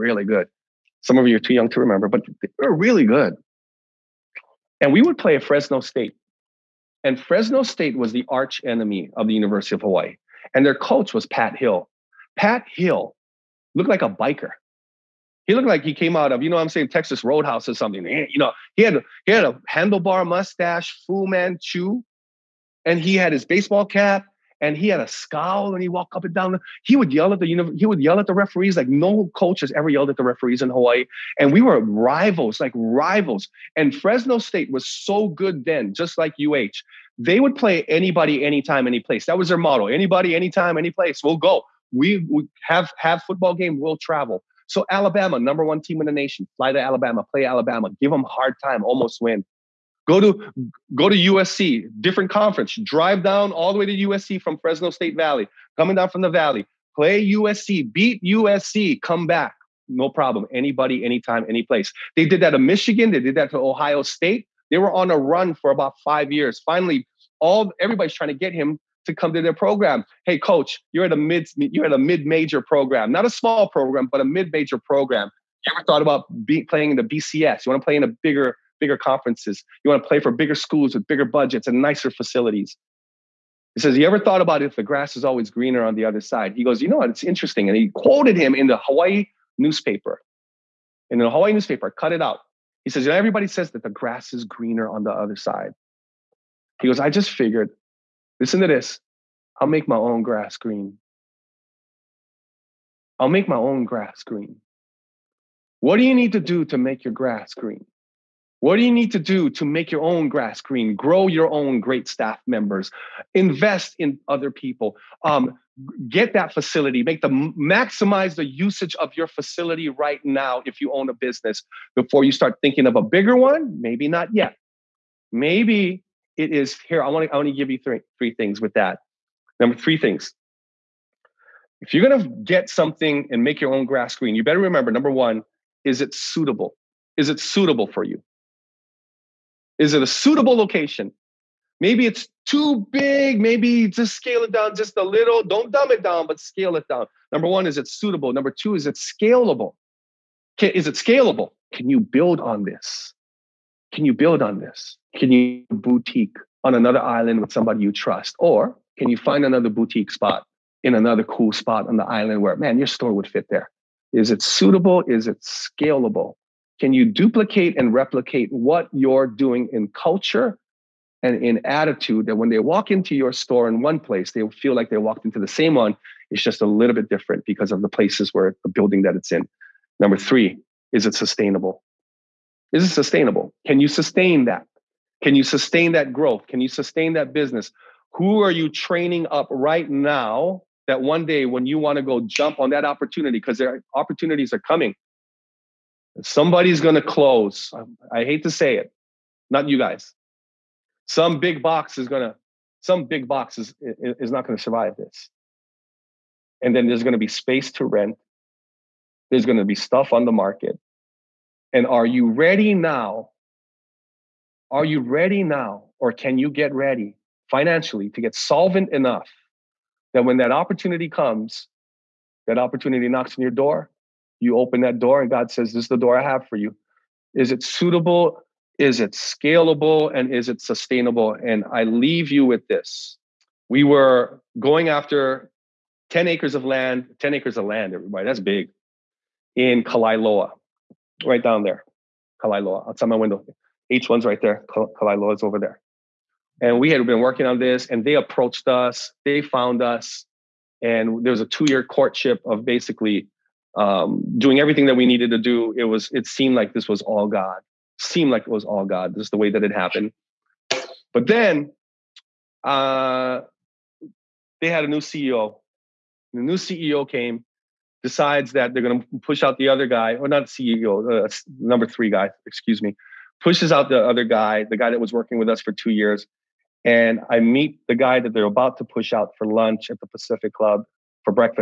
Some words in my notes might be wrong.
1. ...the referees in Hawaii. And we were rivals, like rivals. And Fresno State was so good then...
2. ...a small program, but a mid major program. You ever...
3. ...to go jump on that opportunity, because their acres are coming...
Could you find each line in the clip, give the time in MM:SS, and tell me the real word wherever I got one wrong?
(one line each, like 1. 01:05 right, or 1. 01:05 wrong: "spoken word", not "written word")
1. 00:30 right
2. 01:13 right
3. 03:11 wrong: "opportunities", not "acres".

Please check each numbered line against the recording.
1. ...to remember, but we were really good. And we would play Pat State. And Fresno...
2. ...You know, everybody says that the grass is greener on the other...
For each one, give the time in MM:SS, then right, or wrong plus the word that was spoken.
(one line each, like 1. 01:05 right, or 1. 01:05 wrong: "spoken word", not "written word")
1. 00:01 wrong: "Fresno", not "Pat"
2. 01:33 right.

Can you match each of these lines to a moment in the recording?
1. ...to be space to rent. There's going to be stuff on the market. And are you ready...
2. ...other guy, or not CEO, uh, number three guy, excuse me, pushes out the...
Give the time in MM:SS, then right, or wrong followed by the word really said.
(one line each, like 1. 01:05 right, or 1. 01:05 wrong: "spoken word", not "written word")
1. 03:27 right
2. 04:29 right.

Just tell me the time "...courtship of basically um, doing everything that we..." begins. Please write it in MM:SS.
04:11.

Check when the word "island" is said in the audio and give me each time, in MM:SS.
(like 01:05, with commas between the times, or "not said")
02:37, 02:42.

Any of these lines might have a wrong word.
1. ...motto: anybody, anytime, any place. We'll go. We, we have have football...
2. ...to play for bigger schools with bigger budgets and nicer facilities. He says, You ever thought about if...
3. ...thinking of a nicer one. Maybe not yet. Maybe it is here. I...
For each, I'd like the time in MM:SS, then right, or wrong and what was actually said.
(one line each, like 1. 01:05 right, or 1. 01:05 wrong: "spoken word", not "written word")
1. 00:39 right
2. 01:20 right
3. 02:02 wrong: "bigger", not "nicer".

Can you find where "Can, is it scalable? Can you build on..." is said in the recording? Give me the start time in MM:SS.
02:30.